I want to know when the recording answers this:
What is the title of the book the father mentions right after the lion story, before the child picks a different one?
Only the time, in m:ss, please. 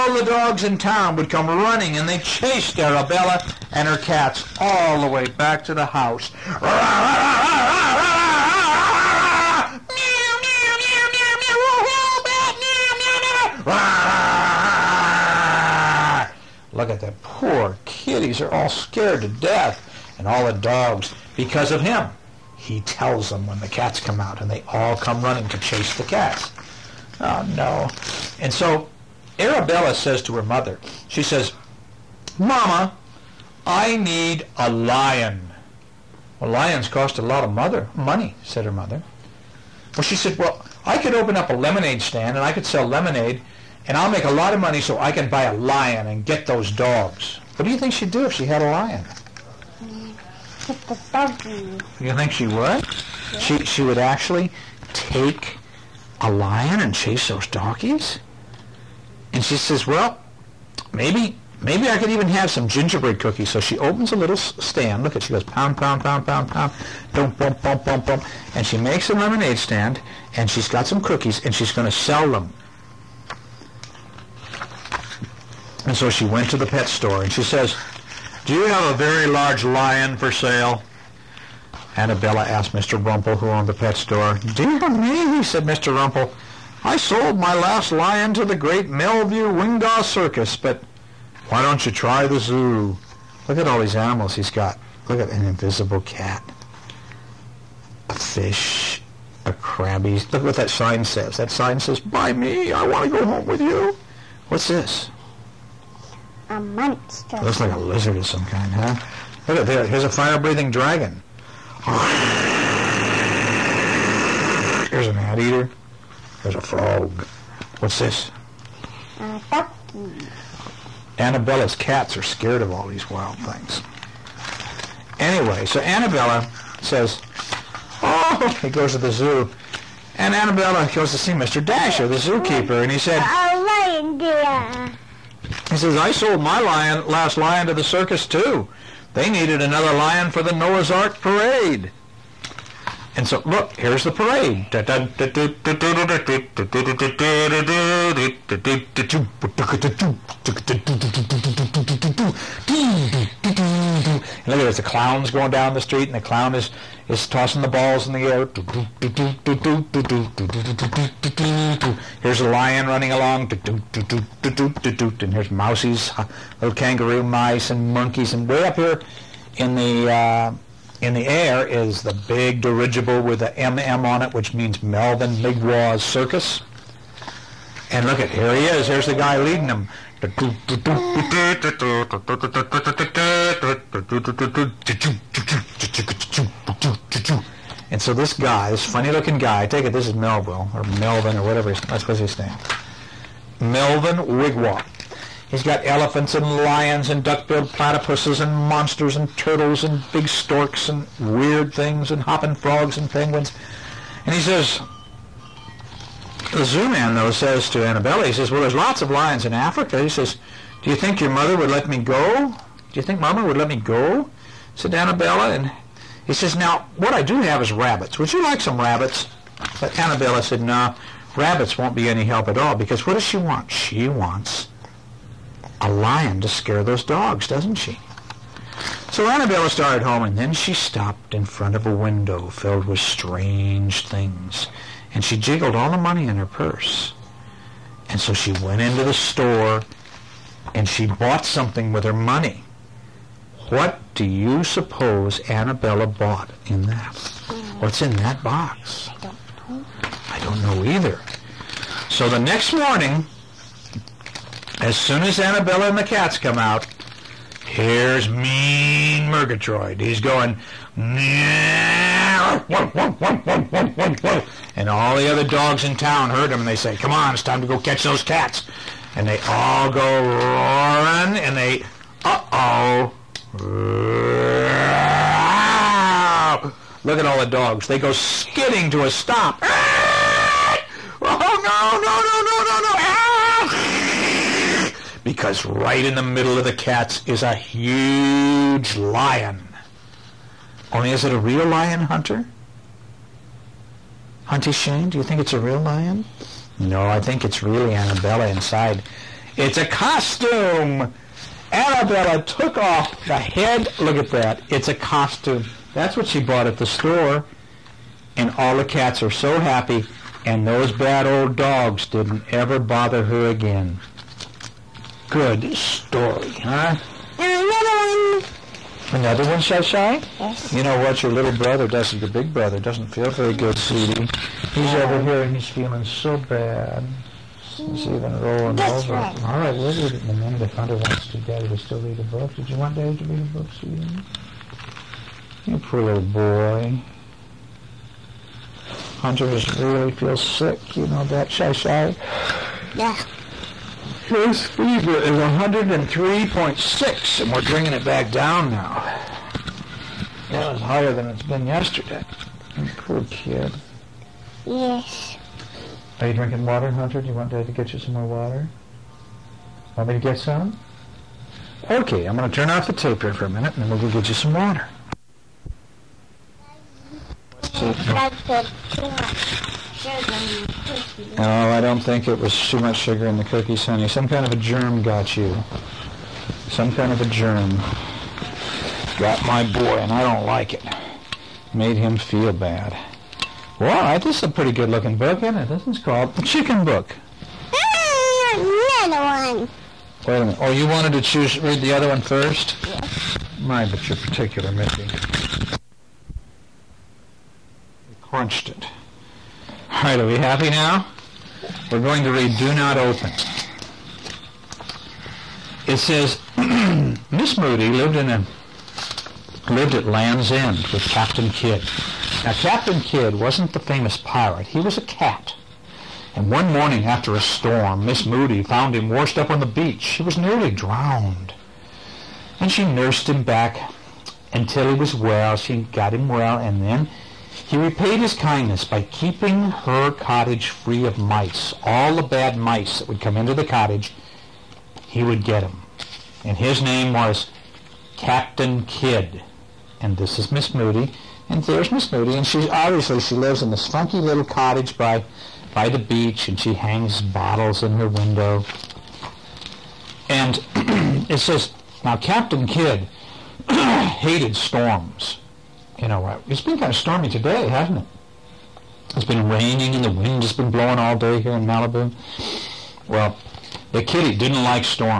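6:26.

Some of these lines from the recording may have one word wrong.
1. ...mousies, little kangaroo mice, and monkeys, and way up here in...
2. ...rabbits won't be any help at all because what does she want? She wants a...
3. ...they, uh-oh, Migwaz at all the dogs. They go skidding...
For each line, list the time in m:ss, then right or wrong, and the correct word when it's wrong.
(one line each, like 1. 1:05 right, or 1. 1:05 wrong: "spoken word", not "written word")
1. 2:45 right
2. 3:41 right
3. 4:31 wrong: "Look", not "Migwaz".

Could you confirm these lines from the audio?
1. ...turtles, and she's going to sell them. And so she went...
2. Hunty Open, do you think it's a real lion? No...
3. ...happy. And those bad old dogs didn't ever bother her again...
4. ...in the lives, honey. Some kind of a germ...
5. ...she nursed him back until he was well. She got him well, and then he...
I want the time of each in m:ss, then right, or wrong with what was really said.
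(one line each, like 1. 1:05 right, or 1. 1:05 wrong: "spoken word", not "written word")
1. 1:10 wrong: "cookies", not "turtles"
2. 4:54 wrong: "Shane", not "Open"
3. 5:09 right
4. 6:13 wrong: "cookies", not "lives"
5. 7:02 right.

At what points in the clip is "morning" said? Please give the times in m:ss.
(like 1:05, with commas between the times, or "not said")
4:12, 6:56.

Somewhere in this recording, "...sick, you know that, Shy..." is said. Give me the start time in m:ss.
5:40.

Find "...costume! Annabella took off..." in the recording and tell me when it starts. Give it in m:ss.
4:59.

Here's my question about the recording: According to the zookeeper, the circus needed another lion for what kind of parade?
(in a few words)
Noah's Ark parade.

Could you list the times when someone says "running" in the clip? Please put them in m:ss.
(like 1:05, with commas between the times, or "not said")
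0:01, 0:25, 2:42.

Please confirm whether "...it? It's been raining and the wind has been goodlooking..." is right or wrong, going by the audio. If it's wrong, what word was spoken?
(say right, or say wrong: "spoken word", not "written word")
wrong: "blowing", not "goodlooking".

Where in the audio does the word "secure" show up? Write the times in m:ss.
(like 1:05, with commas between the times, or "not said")
not said.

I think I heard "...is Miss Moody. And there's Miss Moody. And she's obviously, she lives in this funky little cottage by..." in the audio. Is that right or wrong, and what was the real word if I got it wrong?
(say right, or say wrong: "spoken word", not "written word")
right.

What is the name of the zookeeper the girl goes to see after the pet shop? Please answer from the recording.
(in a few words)
Mr. Dasher.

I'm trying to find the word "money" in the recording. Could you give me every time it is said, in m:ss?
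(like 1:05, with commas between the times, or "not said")
0:37, 0:44, 3:55, 4:02.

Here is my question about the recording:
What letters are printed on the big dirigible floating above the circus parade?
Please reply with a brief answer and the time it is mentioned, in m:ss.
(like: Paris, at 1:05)
MM, at 2:53.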